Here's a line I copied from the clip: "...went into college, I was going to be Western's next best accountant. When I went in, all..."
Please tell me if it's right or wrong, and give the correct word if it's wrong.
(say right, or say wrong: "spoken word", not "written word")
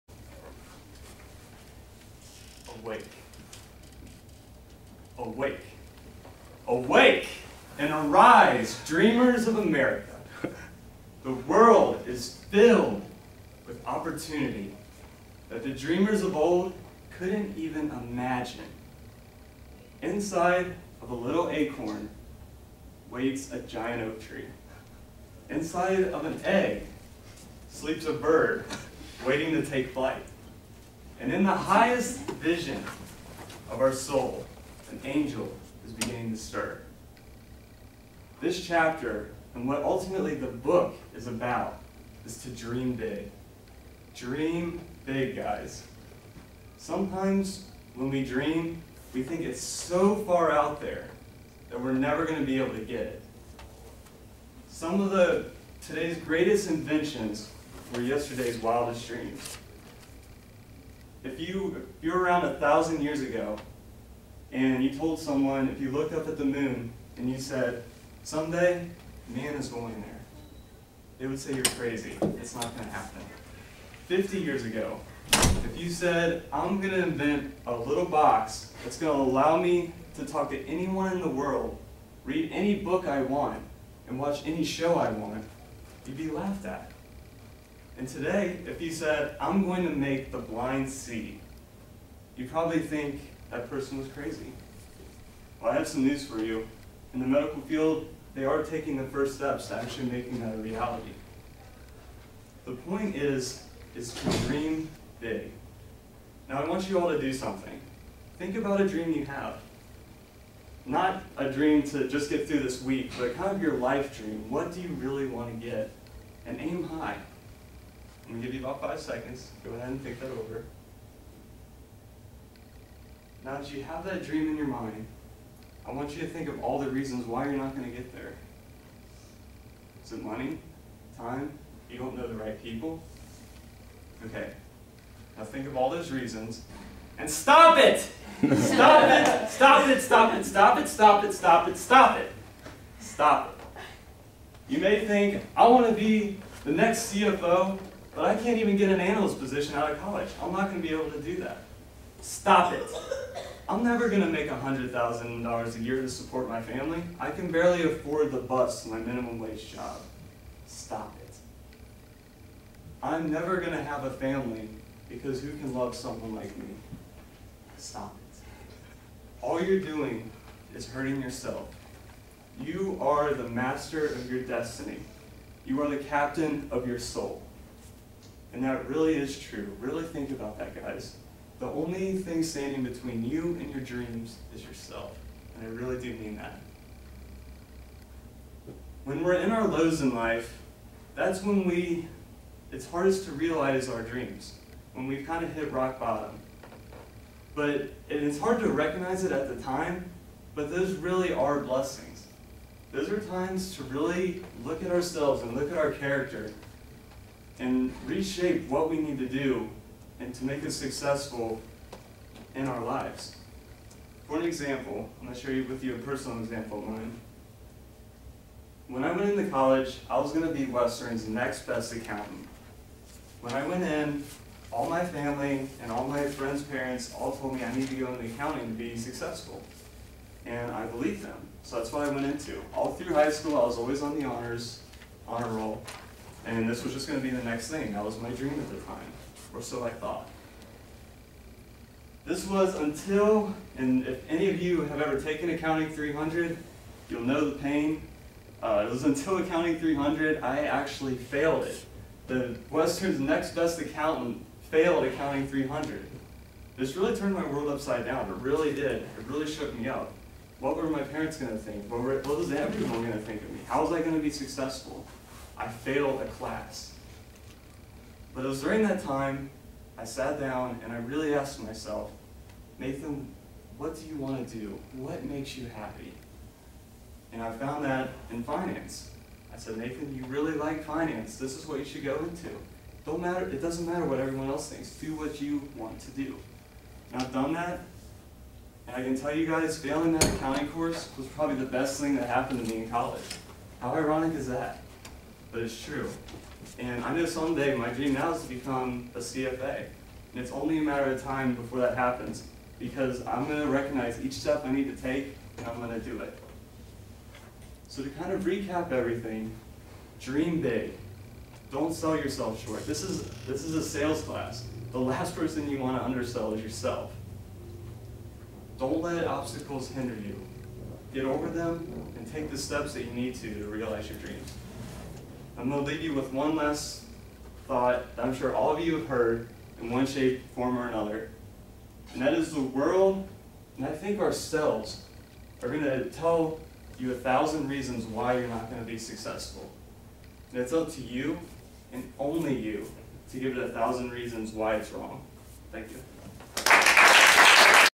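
right.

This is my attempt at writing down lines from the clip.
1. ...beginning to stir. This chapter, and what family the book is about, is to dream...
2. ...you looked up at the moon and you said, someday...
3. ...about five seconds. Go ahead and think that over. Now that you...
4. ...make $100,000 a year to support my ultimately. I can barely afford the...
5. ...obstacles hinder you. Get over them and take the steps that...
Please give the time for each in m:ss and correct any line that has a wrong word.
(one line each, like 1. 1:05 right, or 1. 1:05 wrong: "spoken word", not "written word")
1. 0:35 wrong: "ultimately", not "family"
2. 1:05 right
3. 1:58 right
4. 2:34 wrong: "family", not "ultimately"
5. 5:19 right.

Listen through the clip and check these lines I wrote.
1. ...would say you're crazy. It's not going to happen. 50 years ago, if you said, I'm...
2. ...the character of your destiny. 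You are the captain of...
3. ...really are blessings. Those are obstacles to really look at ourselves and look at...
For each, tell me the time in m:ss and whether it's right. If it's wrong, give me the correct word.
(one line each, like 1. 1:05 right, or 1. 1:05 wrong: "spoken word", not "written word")
1. 1:11 right
2. 2:53 wrong: "master", not "character"
3. 3:20 wrong: "times", not "obstacles".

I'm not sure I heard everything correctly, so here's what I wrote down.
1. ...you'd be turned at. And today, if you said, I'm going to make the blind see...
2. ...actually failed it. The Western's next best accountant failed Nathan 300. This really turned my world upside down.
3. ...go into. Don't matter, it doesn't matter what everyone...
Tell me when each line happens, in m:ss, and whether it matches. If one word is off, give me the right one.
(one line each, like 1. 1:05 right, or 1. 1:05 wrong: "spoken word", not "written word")
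1. 1:26 wrong: "laughed", not "turned"
2. 4:10 wrong: "Accounting", not "Nathan"
3. 4:42 right.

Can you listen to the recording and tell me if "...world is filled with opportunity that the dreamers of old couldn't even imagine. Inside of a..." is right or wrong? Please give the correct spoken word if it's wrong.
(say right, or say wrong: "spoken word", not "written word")
right.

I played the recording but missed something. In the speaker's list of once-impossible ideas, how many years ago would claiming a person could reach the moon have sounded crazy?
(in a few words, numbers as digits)
1000.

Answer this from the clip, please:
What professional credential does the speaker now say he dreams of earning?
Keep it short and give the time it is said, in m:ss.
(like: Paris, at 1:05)
CFA, at 4:59.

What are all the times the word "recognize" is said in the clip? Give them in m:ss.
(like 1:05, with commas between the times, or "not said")
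3:18, 5:03.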